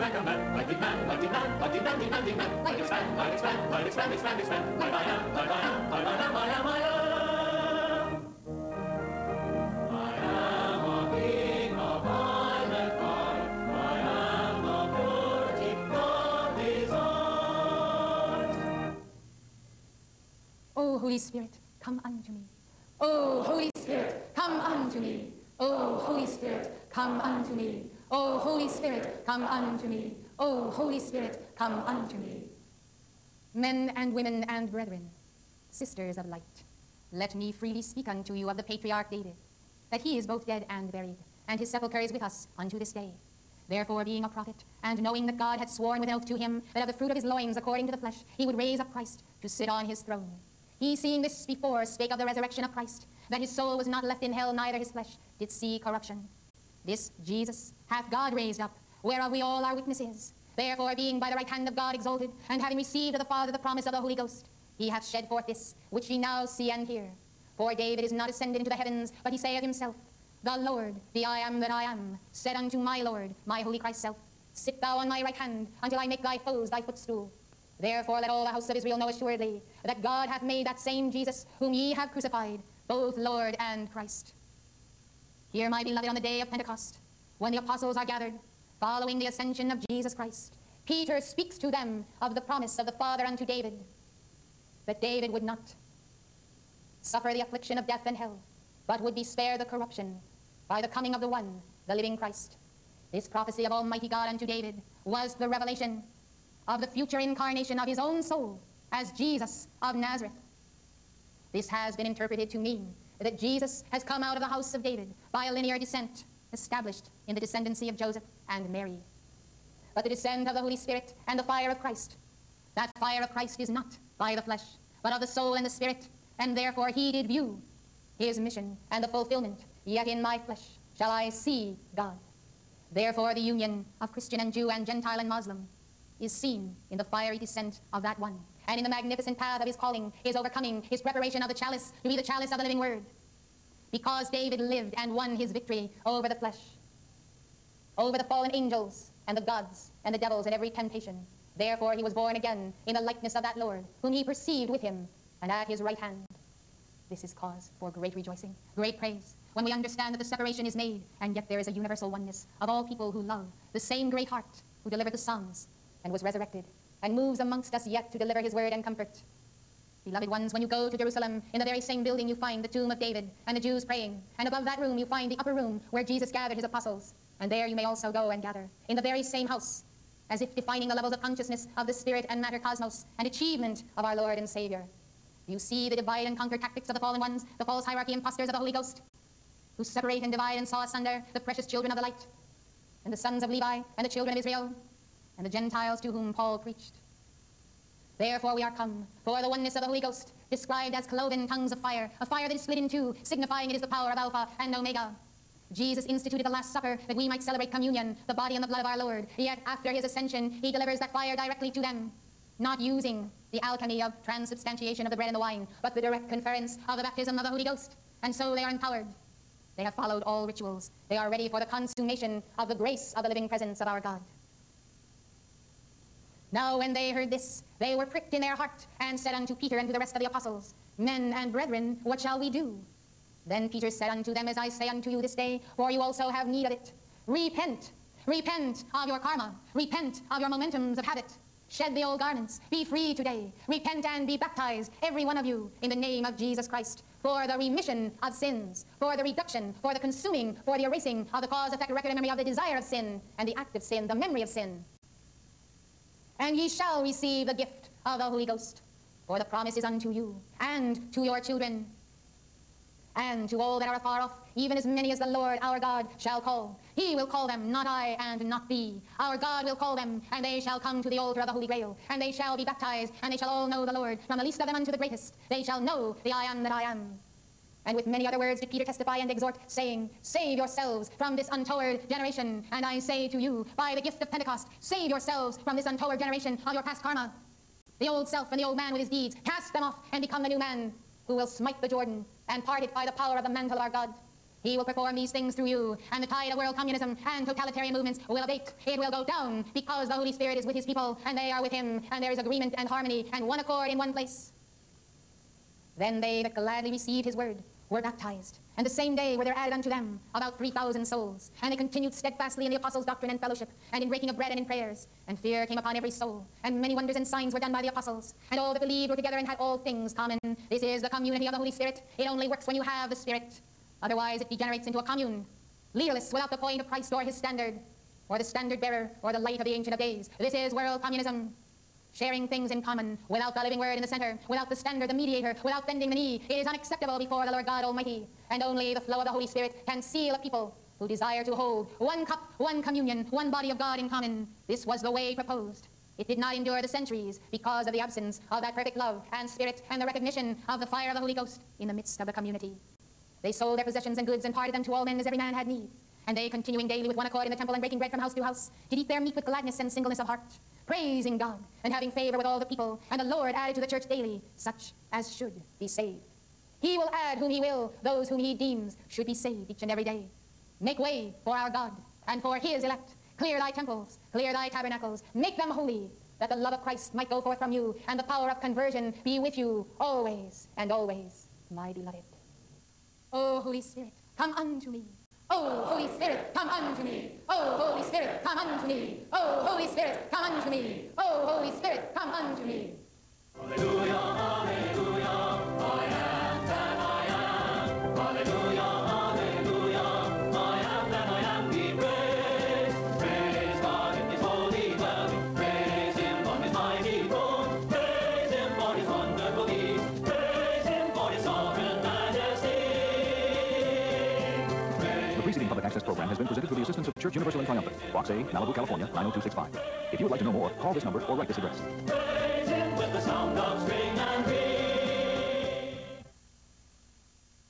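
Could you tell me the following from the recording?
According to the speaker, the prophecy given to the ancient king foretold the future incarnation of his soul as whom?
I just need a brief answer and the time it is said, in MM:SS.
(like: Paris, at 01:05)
Jesus of Nazareth, at 01:49.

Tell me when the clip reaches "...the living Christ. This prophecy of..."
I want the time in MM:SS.
01:41.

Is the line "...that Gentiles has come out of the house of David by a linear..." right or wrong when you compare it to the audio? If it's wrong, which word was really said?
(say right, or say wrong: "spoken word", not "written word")
wrong: "Jesus", not "Gentiles".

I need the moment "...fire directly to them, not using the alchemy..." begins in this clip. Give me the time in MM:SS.
03:31.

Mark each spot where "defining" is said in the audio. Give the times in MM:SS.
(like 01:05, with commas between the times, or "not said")
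03:00.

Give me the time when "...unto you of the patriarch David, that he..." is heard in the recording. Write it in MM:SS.
00:38.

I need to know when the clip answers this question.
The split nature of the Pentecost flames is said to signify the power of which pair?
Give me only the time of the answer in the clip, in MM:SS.
03:24.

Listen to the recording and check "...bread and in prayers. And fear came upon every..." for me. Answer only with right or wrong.
right.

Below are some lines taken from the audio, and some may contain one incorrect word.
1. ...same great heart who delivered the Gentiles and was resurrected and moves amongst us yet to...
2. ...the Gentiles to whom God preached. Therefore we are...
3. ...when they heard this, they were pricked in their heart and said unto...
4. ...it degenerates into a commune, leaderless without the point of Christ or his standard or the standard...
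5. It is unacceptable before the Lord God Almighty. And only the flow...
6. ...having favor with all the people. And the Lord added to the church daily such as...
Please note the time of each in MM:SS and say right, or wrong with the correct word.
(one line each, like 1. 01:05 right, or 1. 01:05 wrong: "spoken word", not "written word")
1. 02:43 wrong: "Psalms", not "Gentiles"
2. 03:15 wrong: "Paul", not "God"
3. 03:46 right
4. 05:24 right
5. 05:36 right
6. 06:01 right.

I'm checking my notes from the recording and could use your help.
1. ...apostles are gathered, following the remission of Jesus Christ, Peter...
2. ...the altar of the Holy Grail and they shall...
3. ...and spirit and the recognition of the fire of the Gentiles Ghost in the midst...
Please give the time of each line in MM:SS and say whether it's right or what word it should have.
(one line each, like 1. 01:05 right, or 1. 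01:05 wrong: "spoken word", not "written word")
1. 01:27 wrong: "ascension", not "remission"
2. 04:31 right
3. 05:49 wrong: "Holy", not "Gentiles".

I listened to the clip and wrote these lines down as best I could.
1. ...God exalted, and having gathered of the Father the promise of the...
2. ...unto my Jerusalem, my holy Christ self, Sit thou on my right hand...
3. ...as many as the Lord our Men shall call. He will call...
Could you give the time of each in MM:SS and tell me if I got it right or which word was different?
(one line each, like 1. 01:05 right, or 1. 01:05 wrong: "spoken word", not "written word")
1. 01:01 wrong: "received", not "gathered"
2. 01:12 wrong: "Lord", not "Jerusalem"
3. 04:24 wrong: "God", not "Men".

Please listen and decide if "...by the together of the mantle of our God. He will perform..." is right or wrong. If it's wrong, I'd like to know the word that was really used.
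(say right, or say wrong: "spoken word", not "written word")
wrong: "power", not "together".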